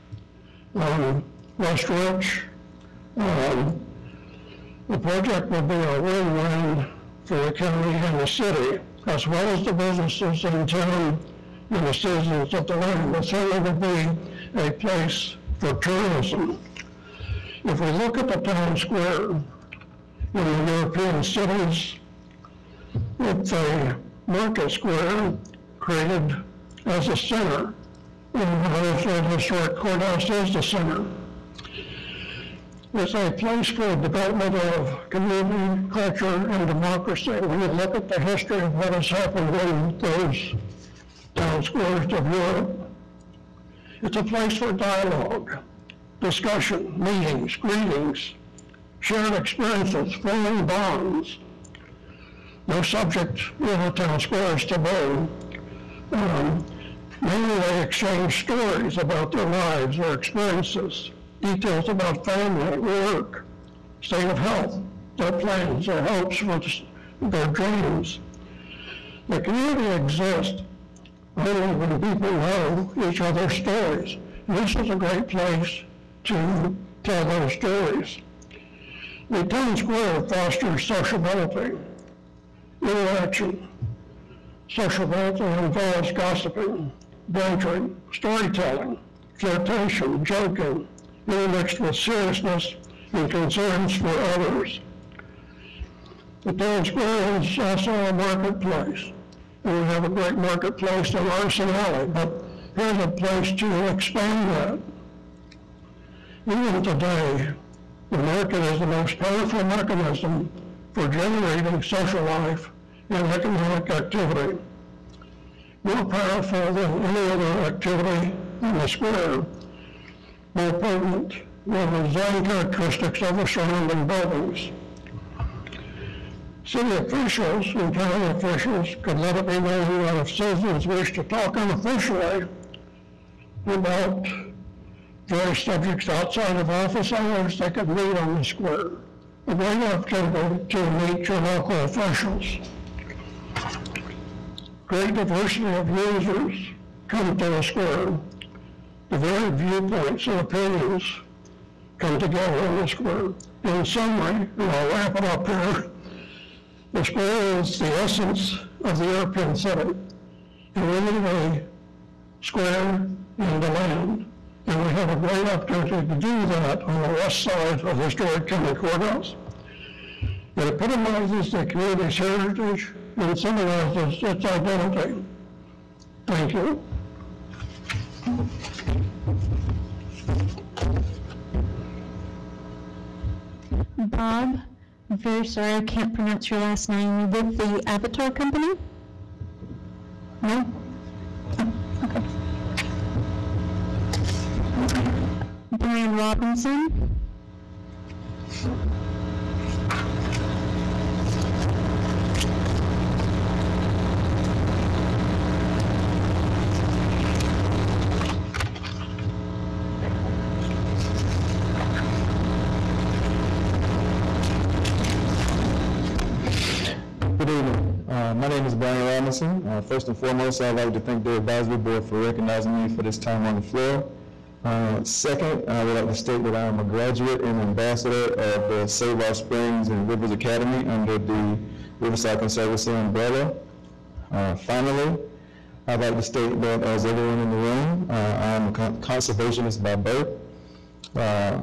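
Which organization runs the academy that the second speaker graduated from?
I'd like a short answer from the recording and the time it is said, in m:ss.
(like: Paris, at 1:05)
Riverside Conservancy, at 3:51.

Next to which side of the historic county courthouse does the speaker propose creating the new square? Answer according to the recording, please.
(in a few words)
West side.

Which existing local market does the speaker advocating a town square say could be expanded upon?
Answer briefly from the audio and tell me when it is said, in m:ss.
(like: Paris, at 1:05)
Artisan Alley, at 1:41.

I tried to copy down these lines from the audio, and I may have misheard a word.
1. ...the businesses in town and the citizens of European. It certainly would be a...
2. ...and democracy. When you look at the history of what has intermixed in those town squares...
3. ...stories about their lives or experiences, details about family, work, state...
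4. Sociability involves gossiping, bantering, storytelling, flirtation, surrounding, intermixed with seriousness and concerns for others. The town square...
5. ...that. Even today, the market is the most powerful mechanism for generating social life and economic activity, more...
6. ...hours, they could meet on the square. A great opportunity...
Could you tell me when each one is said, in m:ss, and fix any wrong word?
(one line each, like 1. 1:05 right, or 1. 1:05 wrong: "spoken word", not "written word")
1. 0:09 wrong: "DeLand", not "European"
2. 0:36 wrong: "happened", not "intermixed"
3. 0:58 right
4. 1:24 wrong: "joking", not "surrounding"
5. 1:44 right
6. 2:17 right.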